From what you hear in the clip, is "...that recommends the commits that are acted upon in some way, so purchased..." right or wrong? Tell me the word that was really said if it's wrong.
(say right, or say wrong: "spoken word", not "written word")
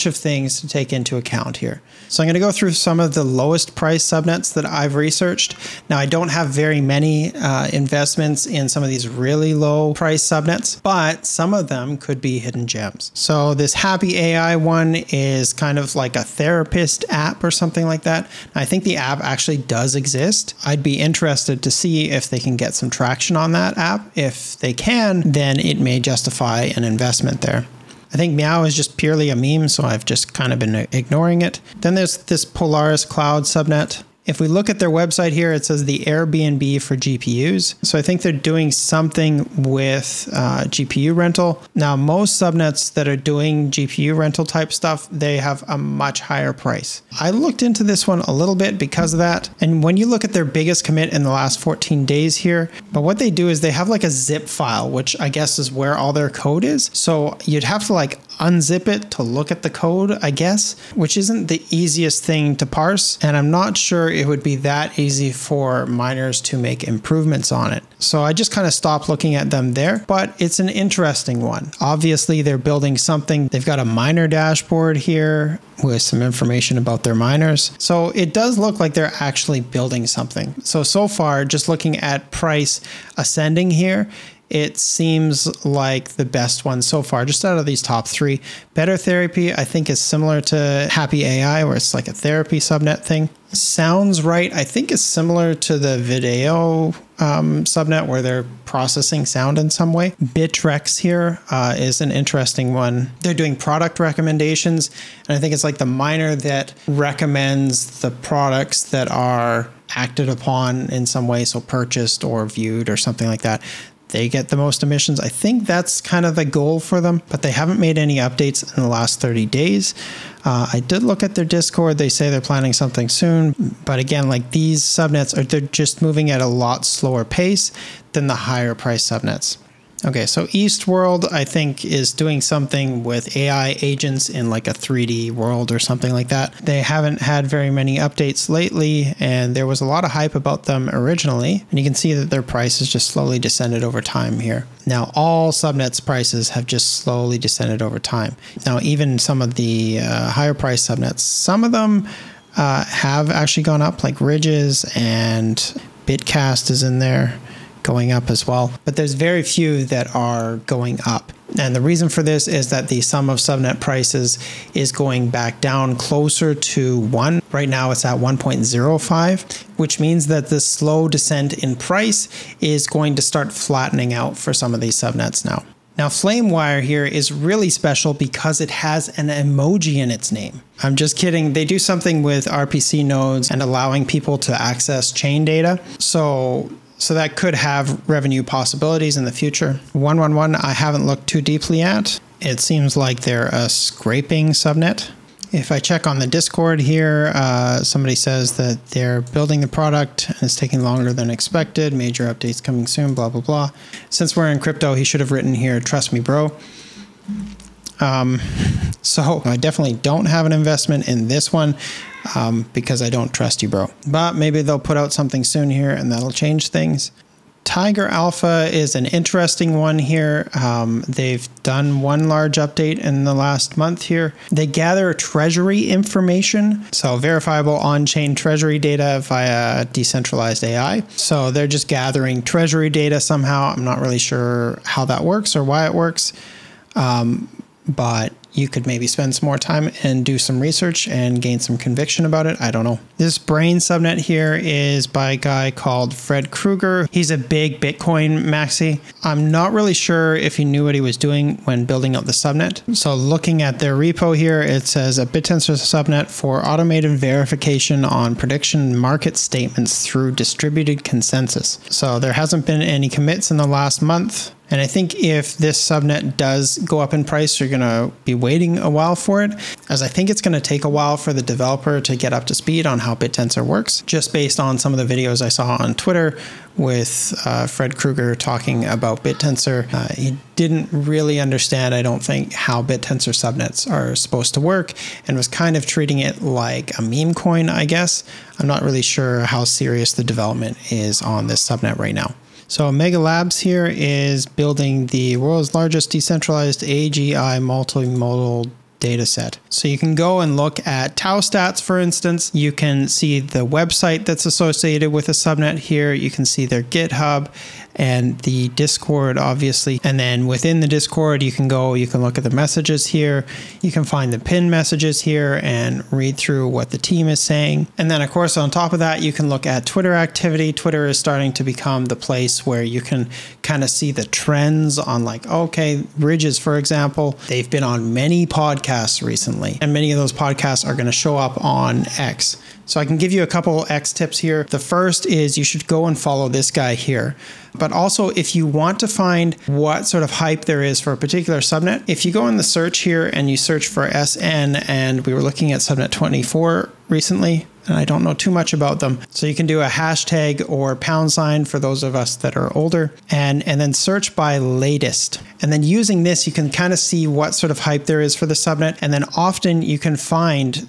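wrong: "products", not "commits".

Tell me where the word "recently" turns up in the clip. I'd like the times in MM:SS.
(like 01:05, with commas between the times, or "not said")
05:29, 05:47.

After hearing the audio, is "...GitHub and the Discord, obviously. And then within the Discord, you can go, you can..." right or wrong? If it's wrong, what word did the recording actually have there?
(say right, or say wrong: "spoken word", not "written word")
right.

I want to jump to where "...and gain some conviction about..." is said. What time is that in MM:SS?
04:01.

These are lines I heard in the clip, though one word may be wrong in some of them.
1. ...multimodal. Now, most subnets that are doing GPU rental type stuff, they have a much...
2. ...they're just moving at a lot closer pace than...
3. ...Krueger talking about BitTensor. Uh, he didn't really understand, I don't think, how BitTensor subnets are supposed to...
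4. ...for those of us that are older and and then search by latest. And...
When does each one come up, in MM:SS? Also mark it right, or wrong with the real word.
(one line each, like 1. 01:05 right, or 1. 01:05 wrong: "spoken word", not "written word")
1. 00:41 wrong: "rental", not "multimodal"
2. 02:05 wrong: "slower", not "closer"
3. 04:37 right
4. 05:51 right.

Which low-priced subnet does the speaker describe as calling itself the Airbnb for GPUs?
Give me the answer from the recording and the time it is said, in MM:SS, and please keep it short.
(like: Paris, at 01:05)
Polaris Cloud, at 00:32.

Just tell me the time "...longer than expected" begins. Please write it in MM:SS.
03:20.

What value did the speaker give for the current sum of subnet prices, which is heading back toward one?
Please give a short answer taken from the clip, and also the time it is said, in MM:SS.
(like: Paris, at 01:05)
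1.05, at 02:48.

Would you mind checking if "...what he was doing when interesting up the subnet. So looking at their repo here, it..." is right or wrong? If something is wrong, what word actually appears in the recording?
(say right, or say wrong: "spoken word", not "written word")
wrong: "building", not "interesting".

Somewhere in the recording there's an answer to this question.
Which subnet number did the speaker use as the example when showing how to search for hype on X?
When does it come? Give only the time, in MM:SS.
05:46.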